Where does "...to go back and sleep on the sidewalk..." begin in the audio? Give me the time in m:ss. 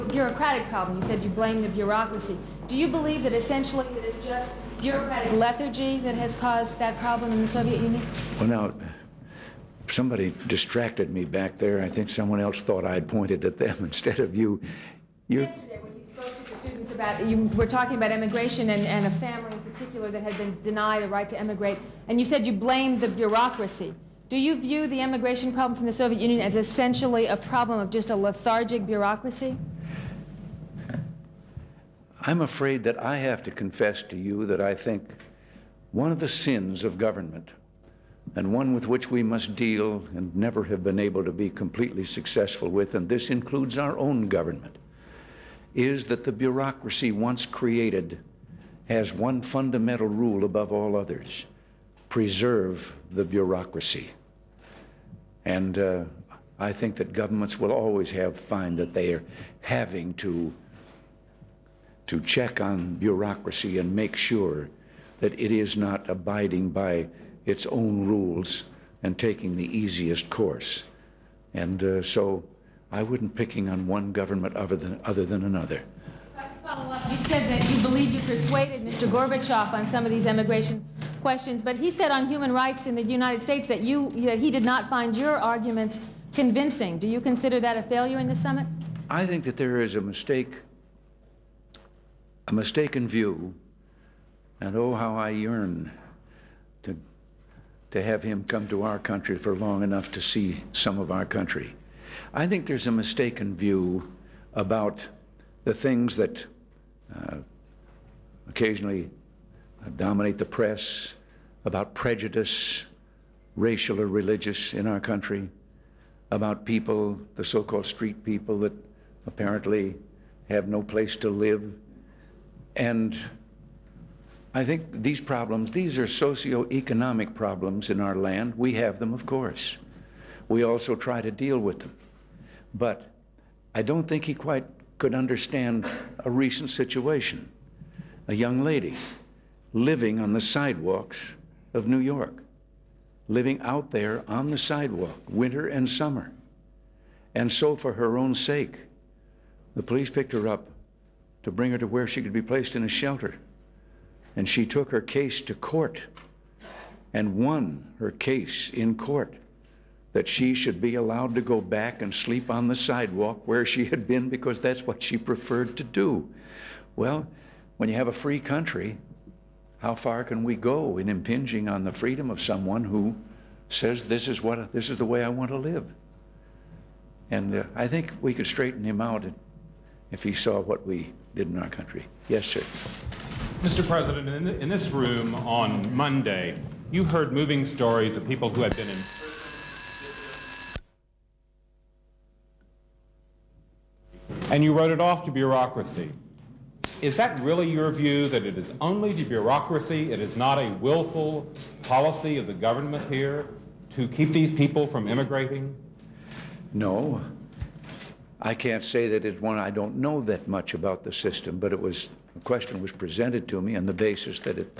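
2:41.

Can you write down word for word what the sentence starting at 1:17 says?
You said that you believe you persuaded Mr.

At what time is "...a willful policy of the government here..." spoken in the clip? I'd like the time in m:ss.
3:20.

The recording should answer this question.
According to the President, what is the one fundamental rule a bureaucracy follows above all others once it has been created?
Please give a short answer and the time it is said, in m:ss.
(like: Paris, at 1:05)
Preserve the bureaucracy, at 0:52.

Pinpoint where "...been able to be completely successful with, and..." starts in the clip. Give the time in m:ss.
0:40.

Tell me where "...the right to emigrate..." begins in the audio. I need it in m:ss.
0:21.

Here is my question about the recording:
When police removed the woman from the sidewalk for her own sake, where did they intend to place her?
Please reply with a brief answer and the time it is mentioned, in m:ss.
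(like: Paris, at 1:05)
A shelter, at 2:32.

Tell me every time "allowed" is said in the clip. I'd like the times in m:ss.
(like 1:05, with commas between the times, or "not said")
2:40.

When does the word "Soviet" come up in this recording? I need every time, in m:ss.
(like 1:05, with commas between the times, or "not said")
0:07, 0:25.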